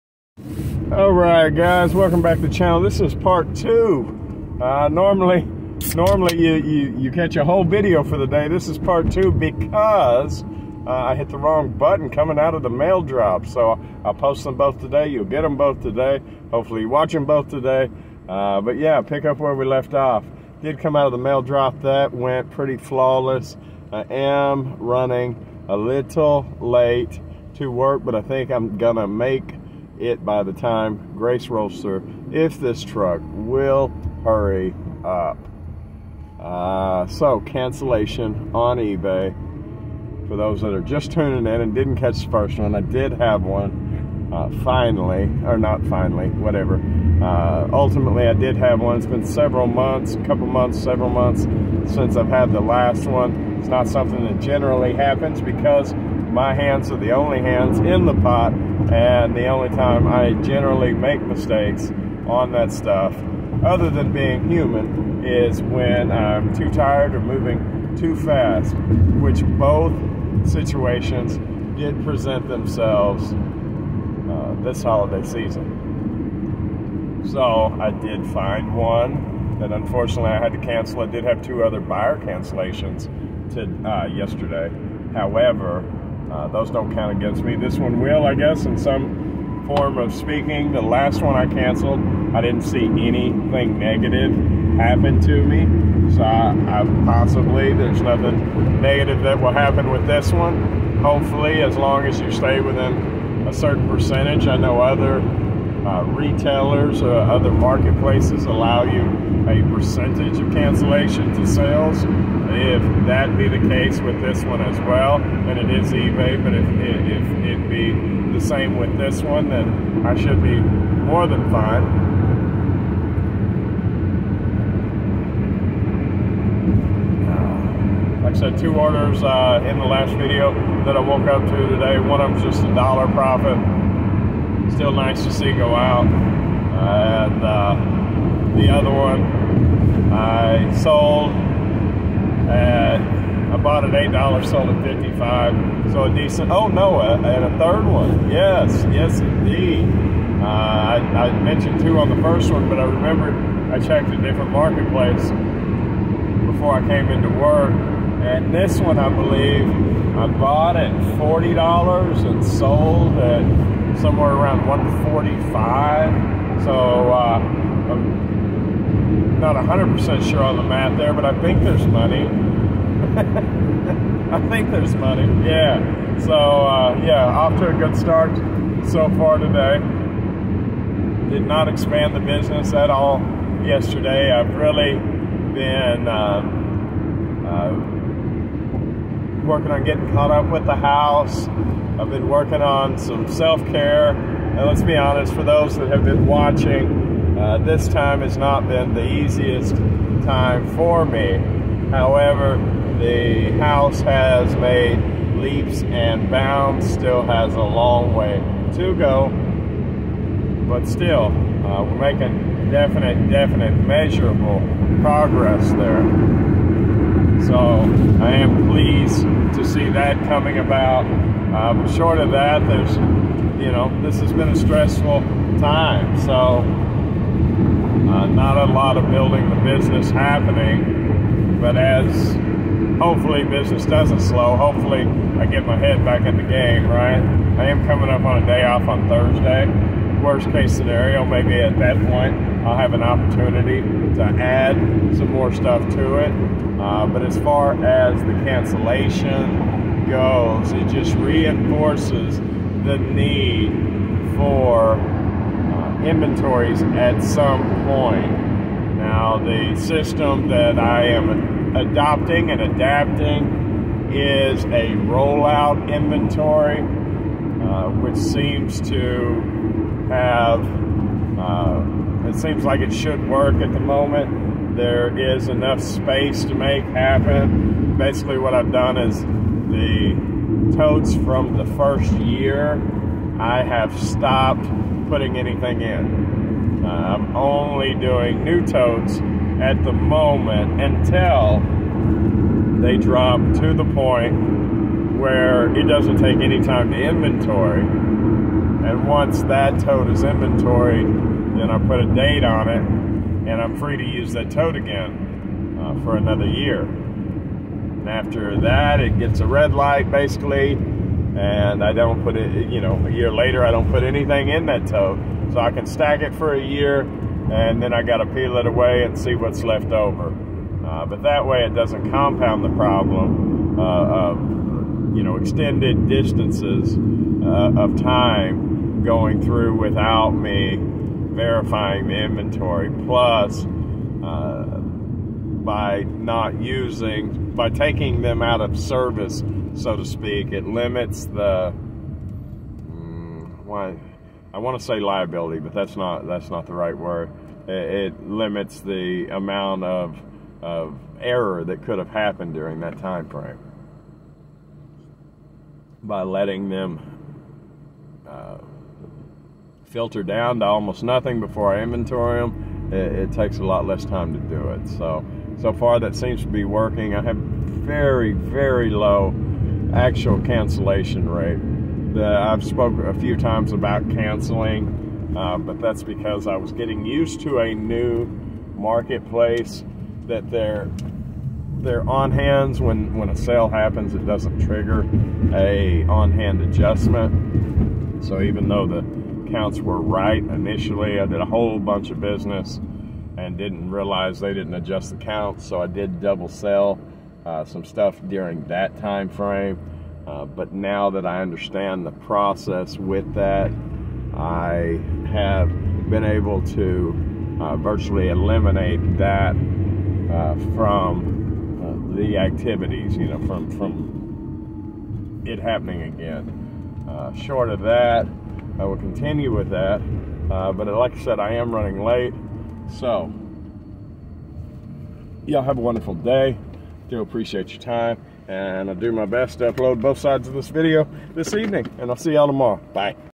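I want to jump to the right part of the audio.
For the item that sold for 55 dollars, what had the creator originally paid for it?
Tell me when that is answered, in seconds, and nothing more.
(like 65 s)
143 s.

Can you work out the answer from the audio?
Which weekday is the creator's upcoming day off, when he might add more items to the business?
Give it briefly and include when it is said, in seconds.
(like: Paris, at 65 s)
Thursday, at 239 s.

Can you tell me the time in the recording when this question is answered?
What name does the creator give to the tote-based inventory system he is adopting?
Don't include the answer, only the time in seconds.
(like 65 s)
265 s.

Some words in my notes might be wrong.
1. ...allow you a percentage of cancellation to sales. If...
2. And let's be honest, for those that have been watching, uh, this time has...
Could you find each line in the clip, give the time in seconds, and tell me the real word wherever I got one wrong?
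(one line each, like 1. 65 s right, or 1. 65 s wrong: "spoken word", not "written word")
1. 108 s right
2. 194 s right.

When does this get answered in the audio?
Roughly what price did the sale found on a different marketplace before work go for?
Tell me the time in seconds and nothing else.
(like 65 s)
164 s.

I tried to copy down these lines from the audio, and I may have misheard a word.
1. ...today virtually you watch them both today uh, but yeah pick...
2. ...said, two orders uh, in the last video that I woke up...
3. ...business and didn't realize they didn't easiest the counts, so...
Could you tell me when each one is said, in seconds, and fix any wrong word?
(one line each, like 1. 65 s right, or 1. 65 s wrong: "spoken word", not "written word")
1. 15 s wrong: "hopefully", not "virtually"
2. 128 s right
3. 392 s wrong: "adjust", not "easiest".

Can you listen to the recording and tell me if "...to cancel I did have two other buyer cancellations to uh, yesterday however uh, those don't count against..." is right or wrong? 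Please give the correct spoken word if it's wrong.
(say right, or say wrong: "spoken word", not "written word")
right.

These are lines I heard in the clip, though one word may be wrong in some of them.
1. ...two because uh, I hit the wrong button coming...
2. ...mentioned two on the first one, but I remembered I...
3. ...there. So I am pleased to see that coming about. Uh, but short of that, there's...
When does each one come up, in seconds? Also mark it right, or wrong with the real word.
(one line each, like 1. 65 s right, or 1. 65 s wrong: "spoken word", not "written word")
1. 9 s right
2. 151 s right
3. 215 s right.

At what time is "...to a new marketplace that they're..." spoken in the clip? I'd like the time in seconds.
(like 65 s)
377 s.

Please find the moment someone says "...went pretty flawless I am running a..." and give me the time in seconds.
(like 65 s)
22 s.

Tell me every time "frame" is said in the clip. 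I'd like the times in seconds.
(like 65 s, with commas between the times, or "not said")
353 s, 399 s.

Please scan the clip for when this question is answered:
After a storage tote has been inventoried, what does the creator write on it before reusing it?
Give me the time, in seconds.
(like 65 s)
301 s.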